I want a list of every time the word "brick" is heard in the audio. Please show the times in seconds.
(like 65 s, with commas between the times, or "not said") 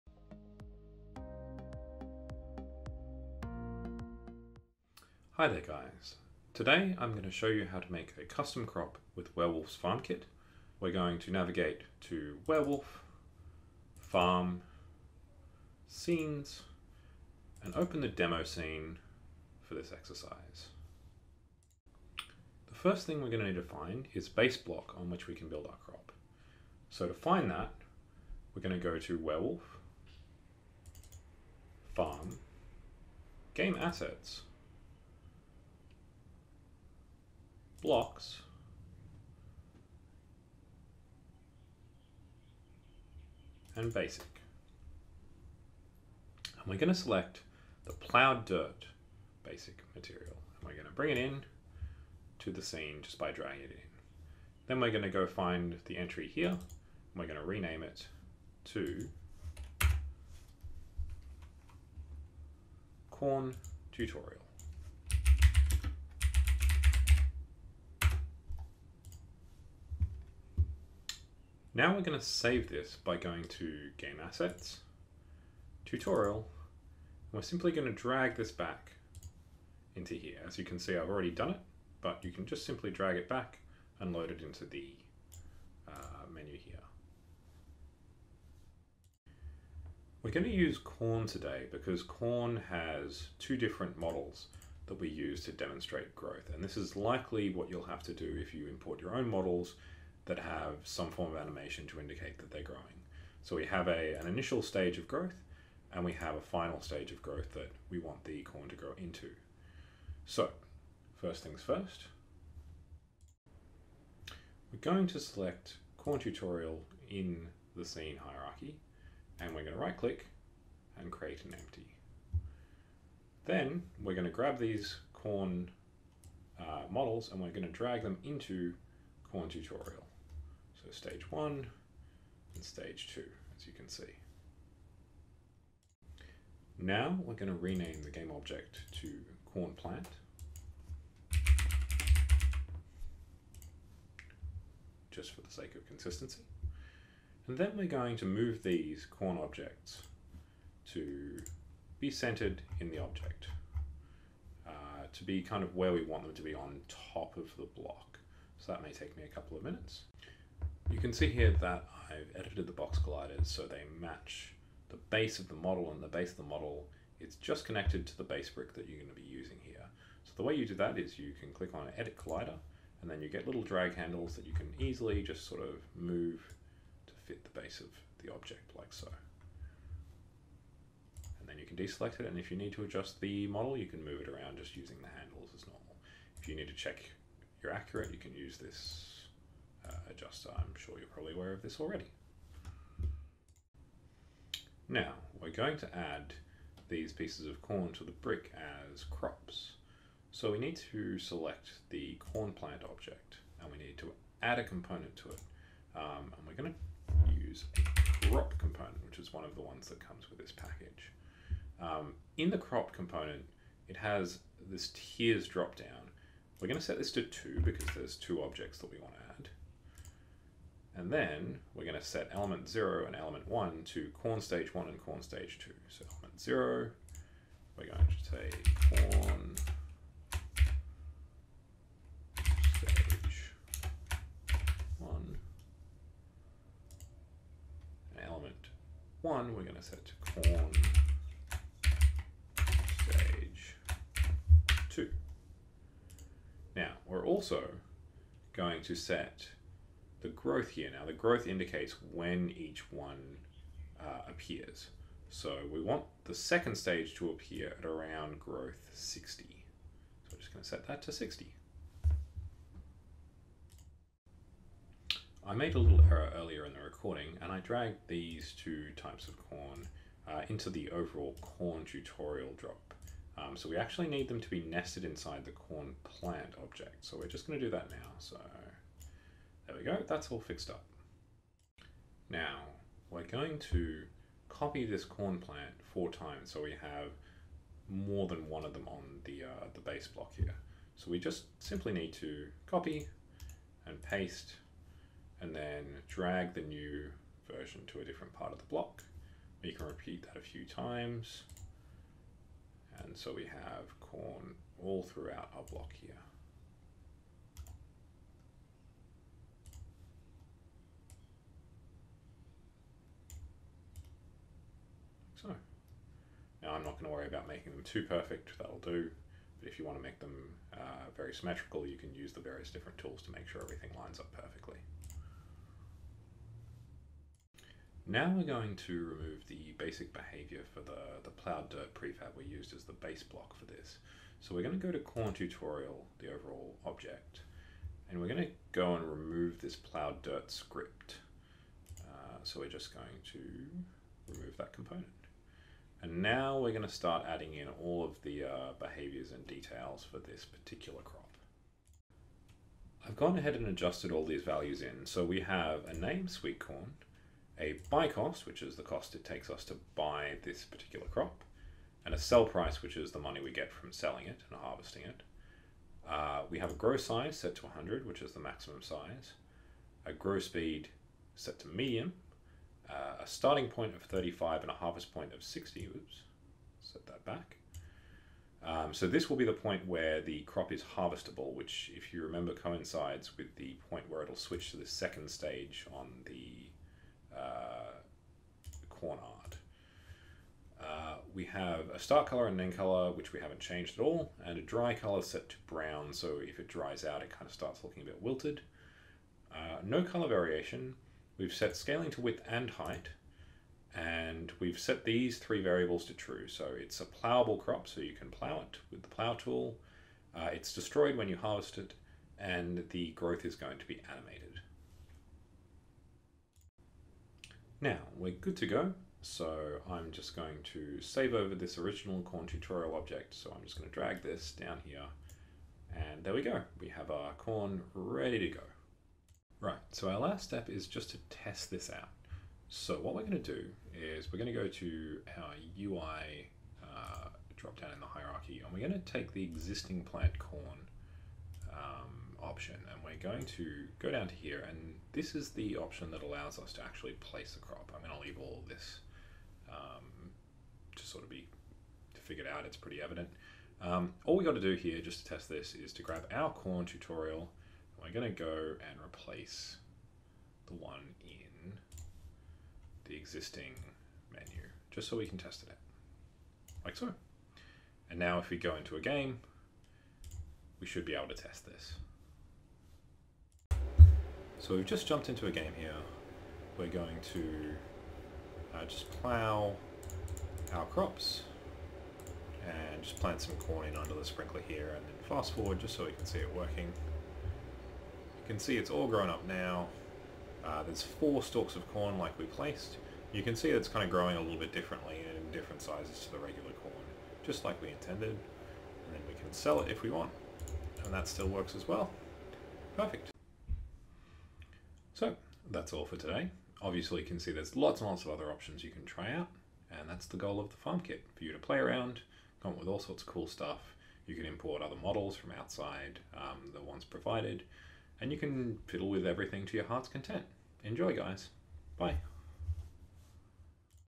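168 s, 198 s.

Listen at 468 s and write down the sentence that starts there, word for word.
And now if we go into a game, we should be able to test this.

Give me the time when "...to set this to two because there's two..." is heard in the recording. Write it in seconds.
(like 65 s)
216 s.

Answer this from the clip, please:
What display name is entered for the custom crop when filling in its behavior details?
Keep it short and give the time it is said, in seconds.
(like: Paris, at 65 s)
sweet corn, at 356 s.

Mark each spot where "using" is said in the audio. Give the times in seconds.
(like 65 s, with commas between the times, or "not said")
169 s, 184 s.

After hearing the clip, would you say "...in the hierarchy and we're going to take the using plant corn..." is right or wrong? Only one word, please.
wrong.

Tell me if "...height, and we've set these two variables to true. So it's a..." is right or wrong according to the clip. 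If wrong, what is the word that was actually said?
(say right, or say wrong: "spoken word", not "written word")
wrong: "three", not "two".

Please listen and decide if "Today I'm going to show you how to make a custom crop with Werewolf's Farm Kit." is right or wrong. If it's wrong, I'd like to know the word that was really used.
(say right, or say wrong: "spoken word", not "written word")
right.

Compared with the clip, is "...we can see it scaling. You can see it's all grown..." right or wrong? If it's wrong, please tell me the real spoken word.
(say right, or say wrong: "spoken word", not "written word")
wrong: "working", not "scaling".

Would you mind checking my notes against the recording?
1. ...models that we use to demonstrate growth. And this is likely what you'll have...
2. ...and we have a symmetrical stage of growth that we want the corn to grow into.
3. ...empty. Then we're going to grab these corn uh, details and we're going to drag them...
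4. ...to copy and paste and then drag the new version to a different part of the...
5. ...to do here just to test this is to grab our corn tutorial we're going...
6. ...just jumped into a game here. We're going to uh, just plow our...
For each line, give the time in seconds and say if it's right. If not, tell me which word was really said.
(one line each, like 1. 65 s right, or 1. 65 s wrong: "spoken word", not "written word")
1. 93 s right
2. 105 s wrong: "final", not "symmetrical"
3. 121 s wrong: "models", not "details"
4. 292 s right
5. 454 s right
6. 474 s right.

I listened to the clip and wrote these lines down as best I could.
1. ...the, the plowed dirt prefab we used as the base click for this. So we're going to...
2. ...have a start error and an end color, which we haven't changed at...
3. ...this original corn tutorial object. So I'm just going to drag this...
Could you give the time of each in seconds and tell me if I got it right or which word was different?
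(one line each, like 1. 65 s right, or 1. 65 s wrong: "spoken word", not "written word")
1. 330 s wrong: "block", not "click"
2. 391 s wrong: "color", not "error"
3. 421 s right.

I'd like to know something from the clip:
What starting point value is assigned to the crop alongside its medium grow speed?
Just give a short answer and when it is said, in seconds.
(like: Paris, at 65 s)
35, at 374 s.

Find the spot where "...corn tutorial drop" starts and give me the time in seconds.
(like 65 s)
271 s.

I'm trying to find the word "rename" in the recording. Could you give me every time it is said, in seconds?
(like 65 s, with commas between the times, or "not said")
57 s, 137 s.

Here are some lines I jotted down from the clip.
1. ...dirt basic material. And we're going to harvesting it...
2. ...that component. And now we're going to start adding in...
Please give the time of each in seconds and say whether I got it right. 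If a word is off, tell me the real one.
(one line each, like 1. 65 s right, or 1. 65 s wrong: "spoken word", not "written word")
1. 48 s wrong: "bring", not "harvesting"
2. 344 s right.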